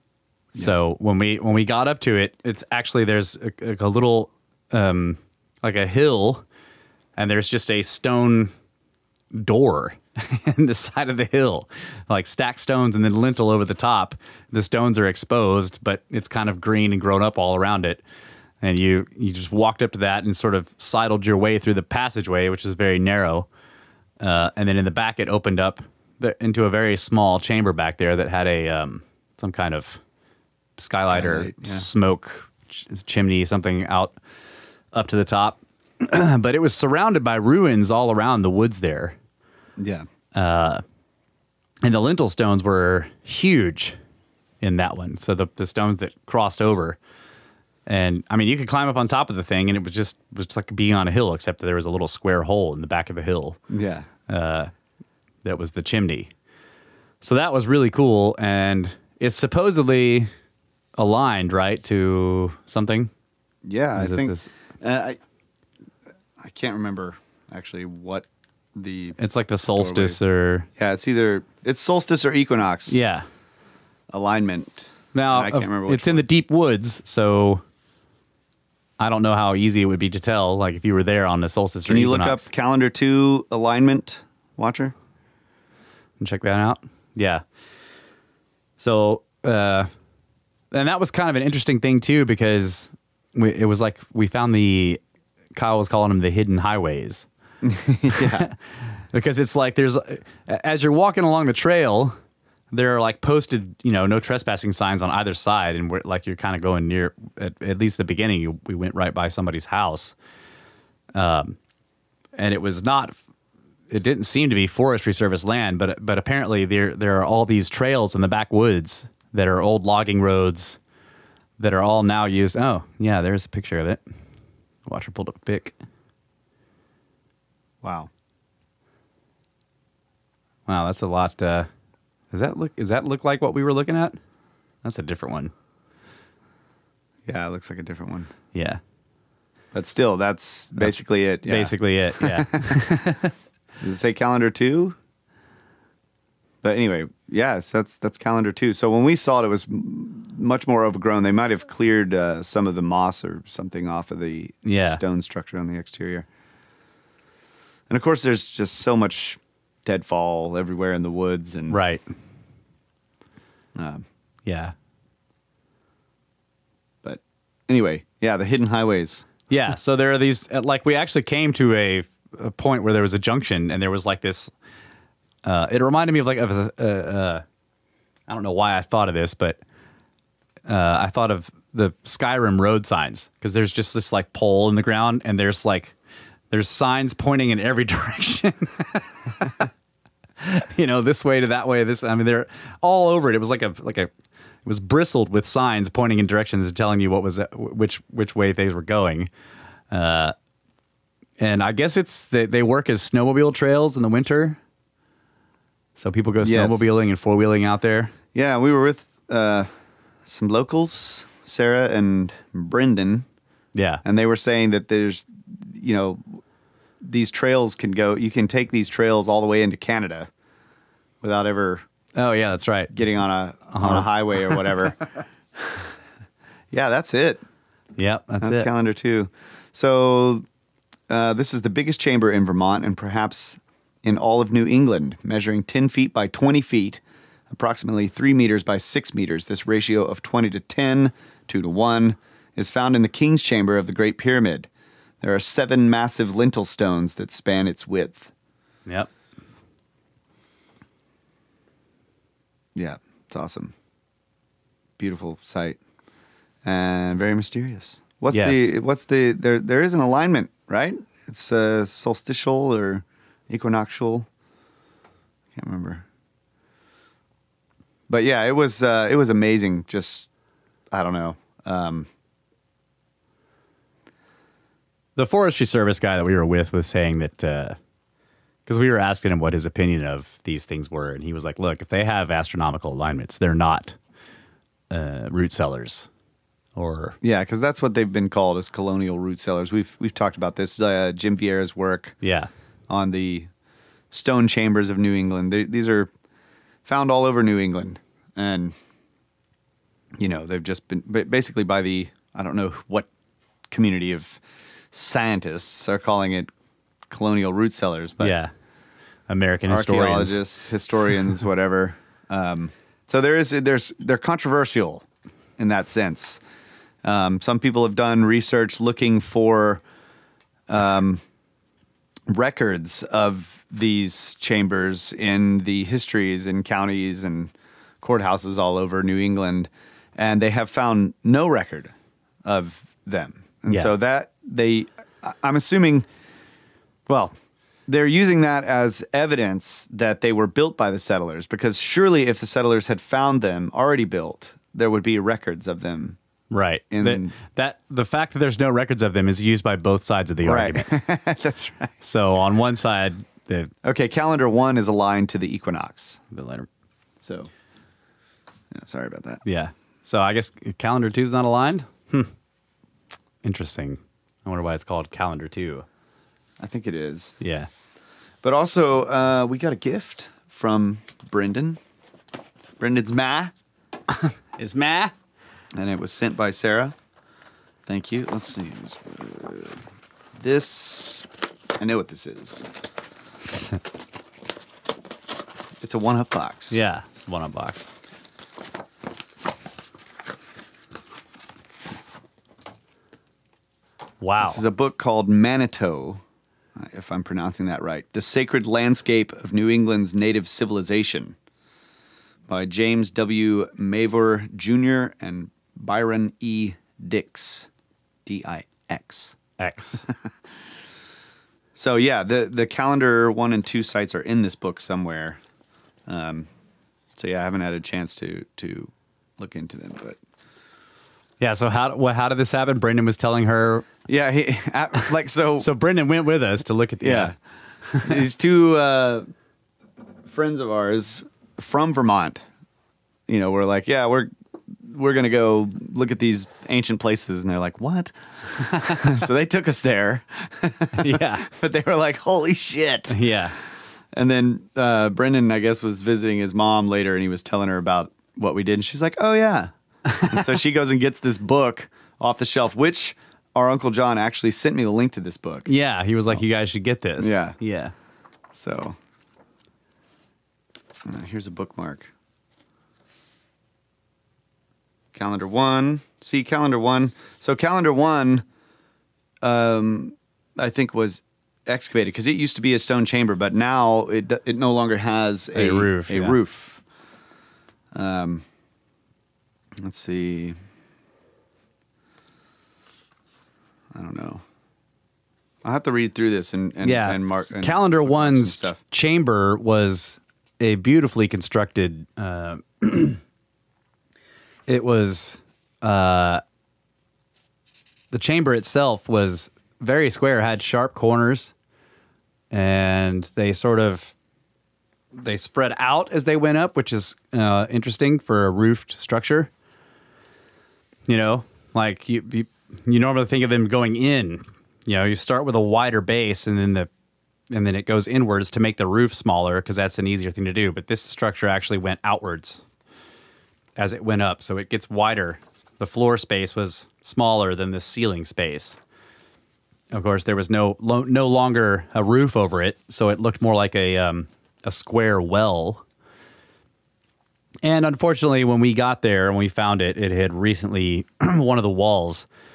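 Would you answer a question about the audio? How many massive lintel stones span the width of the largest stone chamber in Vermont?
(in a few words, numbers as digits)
7.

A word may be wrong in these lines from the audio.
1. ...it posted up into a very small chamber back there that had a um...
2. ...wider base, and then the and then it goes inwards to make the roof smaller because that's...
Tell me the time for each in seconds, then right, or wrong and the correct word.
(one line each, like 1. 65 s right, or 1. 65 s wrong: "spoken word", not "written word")
1. 25 s wrong: "opened", not "posted"
2. 515 s right.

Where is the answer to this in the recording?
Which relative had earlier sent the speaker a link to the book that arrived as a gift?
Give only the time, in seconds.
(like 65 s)
453 s.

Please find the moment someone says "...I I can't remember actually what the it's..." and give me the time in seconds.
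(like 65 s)
65 s.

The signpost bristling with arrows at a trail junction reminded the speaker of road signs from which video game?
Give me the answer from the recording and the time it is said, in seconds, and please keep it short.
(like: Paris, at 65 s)
Skyrim, at 182 s.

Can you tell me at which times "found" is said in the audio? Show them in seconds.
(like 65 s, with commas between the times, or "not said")
94 s, 242 s, 296 s, 330 s, 342 s, 539 s.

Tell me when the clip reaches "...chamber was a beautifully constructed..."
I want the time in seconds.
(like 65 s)
488 s.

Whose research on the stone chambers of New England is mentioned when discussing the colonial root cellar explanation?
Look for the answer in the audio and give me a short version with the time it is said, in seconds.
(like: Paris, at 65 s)
Jim Vieira, at 291 s.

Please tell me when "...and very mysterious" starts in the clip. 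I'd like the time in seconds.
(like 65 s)
256 s.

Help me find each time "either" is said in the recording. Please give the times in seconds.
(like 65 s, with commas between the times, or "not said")
71 s, 105 s.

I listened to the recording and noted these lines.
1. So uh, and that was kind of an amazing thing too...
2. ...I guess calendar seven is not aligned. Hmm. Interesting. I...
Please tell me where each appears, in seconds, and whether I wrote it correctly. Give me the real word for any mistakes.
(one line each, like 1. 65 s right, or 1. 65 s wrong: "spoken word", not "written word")
1. 88 s wrong: "interesting", not "amazing"
2. 360 s wrong: "two", not "seven".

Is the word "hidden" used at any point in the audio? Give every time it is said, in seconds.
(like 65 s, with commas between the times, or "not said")
96 s, 168 s.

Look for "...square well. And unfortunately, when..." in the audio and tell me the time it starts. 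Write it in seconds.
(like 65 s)
534 s.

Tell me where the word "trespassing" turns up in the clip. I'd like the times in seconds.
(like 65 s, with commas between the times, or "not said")
104 s.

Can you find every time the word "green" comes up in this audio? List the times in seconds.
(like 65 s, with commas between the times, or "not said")
16 s.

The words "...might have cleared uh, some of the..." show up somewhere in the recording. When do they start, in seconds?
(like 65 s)
151 s.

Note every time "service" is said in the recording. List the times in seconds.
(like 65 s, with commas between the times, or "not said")
115 s, 275 s.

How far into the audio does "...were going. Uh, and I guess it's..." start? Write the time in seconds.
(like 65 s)
198 s.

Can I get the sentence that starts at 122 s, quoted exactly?
Oh, yeah, there's a picture of it.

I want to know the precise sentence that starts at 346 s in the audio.
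and that, that, the fact that there's no records of them is used by both sides of the right.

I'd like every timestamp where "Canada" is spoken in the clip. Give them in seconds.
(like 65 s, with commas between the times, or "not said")
219 s.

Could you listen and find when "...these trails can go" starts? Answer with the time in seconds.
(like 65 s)
217 s.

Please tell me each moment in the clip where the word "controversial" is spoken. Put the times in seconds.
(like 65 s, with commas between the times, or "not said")
314 s.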